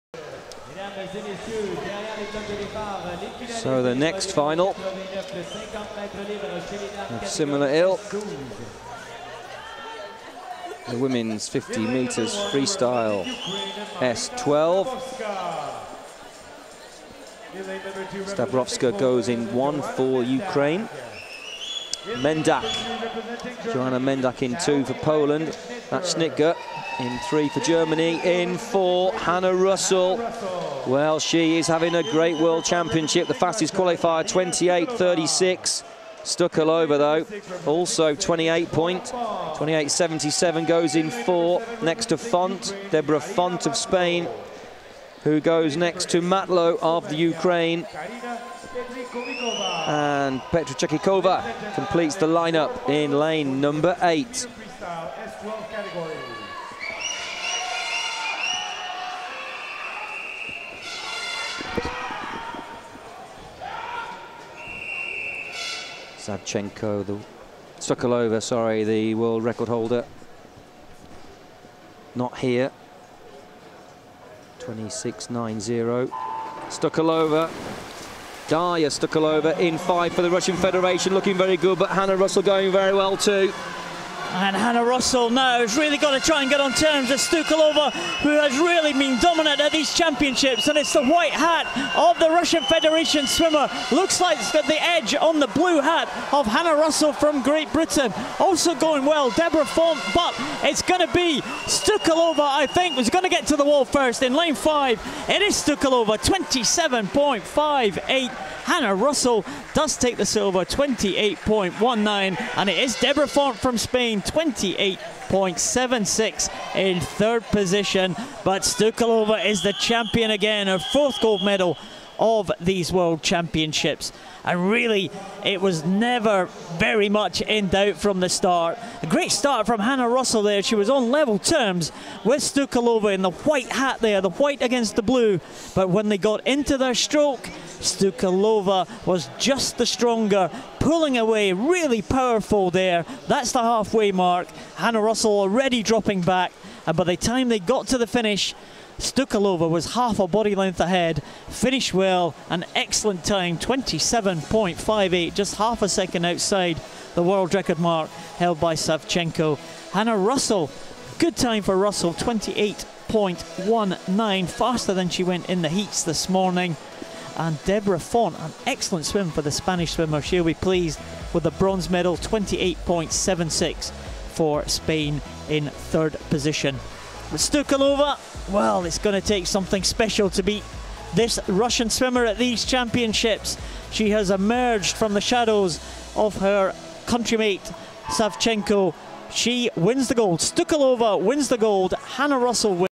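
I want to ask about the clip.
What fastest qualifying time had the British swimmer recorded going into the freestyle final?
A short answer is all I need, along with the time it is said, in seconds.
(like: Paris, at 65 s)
28.36, at 34 s.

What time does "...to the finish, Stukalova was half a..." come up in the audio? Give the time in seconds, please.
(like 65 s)
147 s.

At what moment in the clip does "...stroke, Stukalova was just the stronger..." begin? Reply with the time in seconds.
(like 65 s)
136 s.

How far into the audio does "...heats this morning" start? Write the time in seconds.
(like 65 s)
165 s.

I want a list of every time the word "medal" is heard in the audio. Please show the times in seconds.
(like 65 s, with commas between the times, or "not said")
121 s, 171 s.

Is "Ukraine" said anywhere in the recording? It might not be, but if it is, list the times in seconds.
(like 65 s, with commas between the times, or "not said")
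20 s, 47 s.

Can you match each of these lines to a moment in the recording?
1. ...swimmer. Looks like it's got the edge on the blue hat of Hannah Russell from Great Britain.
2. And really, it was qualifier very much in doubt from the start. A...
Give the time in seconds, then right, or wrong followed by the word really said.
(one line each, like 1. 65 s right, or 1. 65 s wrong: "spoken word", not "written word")
1. 93 s right
2. 124 s wrong: "never", not "qualifier".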